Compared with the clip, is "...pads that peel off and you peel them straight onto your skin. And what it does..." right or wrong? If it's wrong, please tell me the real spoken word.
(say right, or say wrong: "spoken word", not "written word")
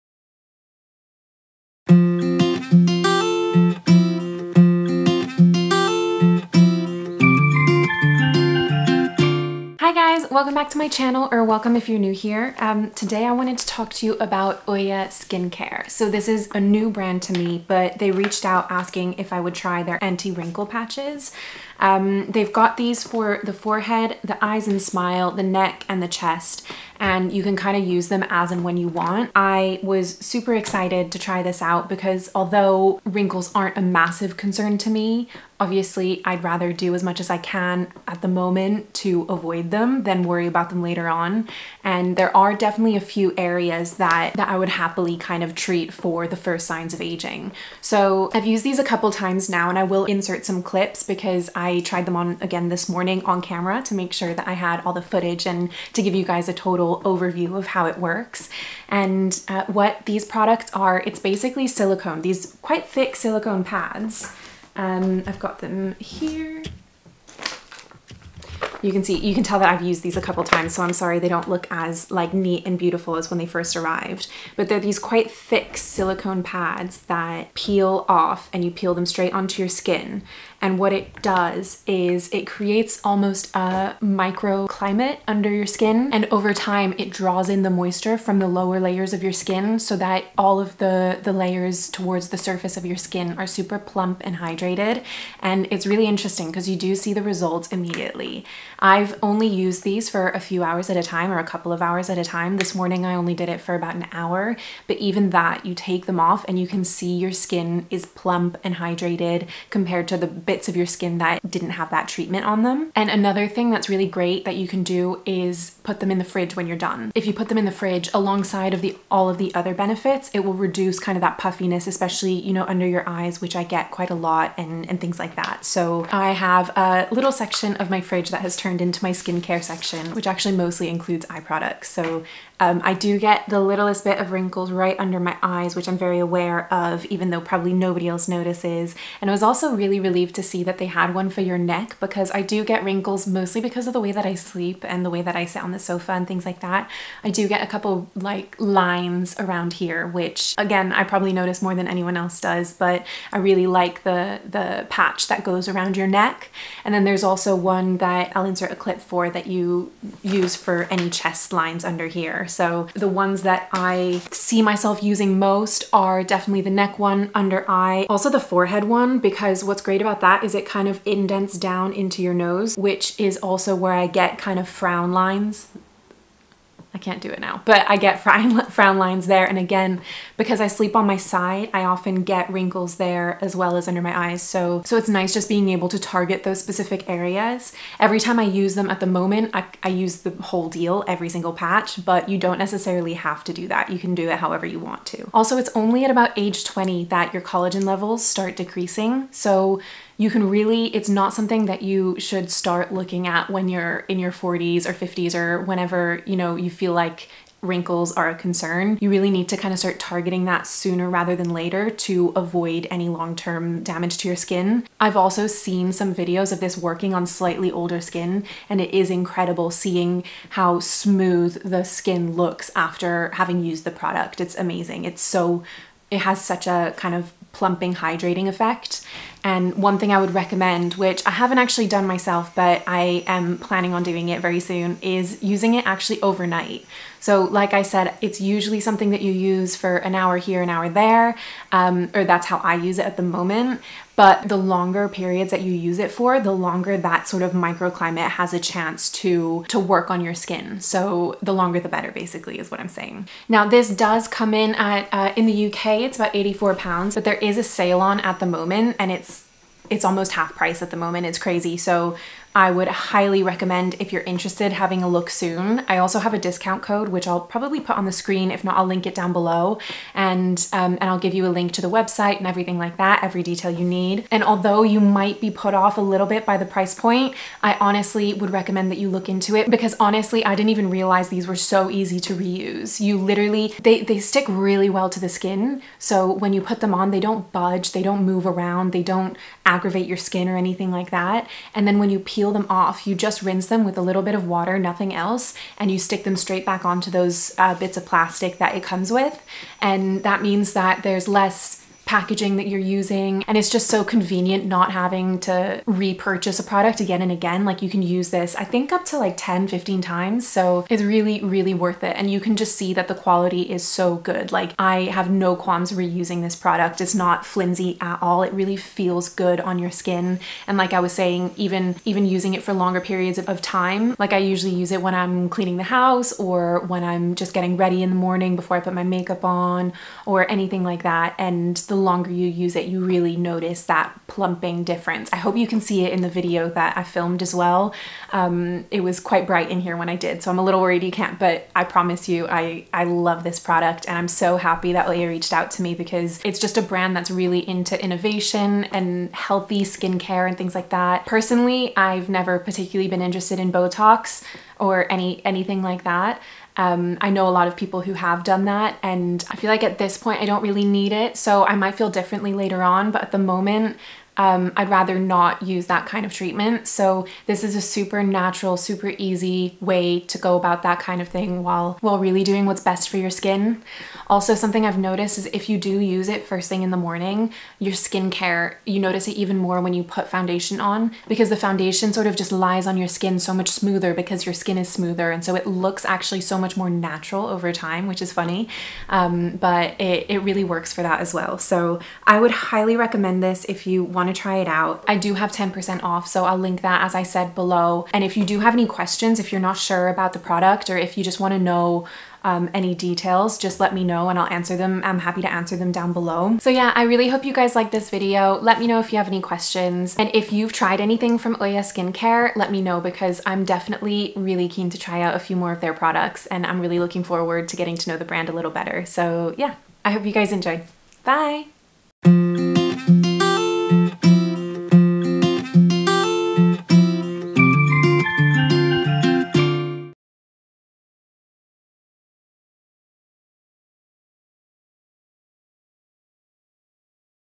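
right.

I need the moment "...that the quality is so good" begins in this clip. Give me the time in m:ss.
5:12.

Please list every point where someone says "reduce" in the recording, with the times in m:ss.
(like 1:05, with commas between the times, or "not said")
2:00.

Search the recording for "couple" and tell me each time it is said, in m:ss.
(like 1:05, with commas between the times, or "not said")
0:48, 1:10, 1:41, 2:27.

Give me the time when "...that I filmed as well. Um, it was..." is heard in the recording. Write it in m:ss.
5:36.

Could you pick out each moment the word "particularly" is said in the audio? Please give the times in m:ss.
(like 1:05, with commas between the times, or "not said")
5:52.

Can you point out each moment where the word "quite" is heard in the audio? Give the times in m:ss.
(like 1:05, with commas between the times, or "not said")
1:02, 1:14, 2:03, 5:39.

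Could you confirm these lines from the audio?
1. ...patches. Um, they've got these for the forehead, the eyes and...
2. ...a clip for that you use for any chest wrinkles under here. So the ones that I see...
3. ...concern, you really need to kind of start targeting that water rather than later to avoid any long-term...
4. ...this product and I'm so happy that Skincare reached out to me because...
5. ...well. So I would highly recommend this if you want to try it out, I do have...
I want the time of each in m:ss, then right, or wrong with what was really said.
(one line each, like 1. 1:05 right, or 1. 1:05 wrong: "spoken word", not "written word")
1. 0:20 right
2. 2:38 wrong: "lines", not "wrinkles"
3. 3:28 wrong: "sooner", not "water"
4. 5:43 wrong: "Oia", not "Skincare"
5. 6:31 right.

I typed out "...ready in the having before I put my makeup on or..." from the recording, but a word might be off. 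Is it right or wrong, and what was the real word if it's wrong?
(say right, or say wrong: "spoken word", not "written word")
wrong: "morning", not "having".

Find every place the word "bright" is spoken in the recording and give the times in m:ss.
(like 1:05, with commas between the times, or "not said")
5:39.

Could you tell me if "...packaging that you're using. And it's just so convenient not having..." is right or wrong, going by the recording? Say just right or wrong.
right.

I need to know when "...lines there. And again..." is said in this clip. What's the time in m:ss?
2:58.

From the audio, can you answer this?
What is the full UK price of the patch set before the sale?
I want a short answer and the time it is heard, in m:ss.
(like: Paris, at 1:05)
84 pounds, at 4:16.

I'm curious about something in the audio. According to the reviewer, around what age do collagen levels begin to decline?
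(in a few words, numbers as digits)
20.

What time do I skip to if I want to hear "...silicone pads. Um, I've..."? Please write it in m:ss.
1:03.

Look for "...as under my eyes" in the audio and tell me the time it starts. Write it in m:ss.
3:03.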